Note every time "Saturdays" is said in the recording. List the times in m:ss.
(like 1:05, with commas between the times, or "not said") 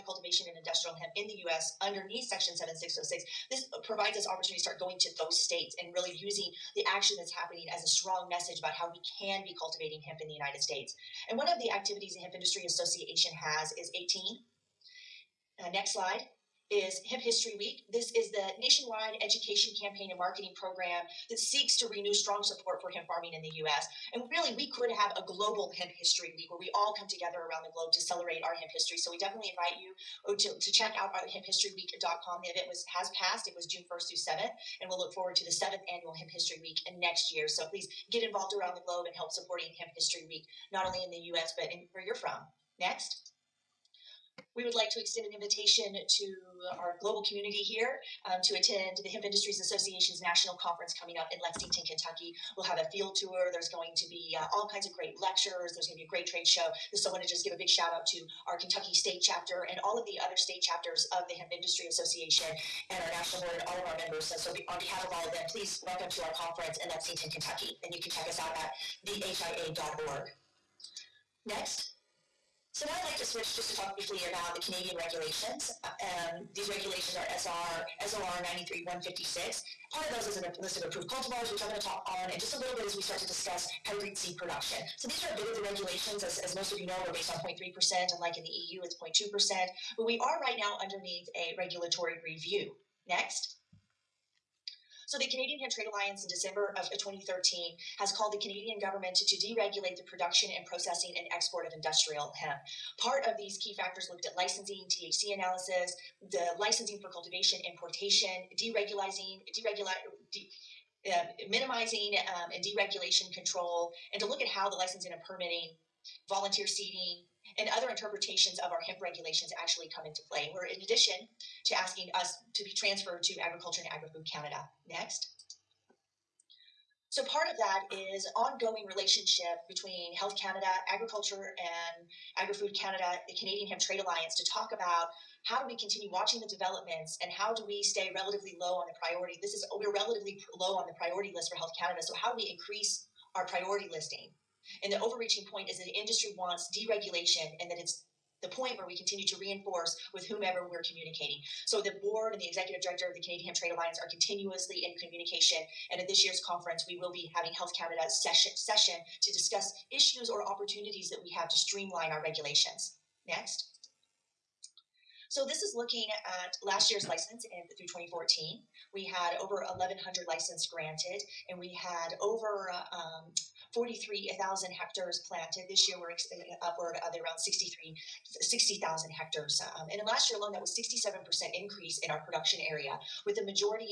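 not said.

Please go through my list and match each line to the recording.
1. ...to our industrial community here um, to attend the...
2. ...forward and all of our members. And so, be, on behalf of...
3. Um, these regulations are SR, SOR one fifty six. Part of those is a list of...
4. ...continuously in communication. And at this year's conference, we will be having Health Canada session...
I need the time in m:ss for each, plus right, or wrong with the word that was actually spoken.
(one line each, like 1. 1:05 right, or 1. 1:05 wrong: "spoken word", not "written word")
1. 0:45 wrong: "global", not "industrial"
2. 1:03 wrong: "board", not "forward"
3. 1:15 right
4. 2:34 right.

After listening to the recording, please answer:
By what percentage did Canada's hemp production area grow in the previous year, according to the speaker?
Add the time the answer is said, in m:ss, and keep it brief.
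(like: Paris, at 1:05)
67%, at 3:00.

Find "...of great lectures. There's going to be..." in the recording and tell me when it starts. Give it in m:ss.
0:54.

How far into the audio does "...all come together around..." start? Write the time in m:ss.
0:26.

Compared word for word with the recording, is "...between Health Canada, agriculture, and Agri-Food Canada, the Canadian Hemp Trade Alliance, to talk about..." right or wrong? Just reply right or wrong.
right.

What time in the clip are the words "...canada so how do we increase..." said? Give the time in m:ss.
2:21.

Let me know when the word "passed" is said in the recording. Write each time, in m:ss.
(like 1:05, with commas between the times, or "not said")
0:33.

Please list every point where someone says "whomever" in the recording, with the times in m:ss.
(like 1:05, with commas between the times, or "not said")
2:30.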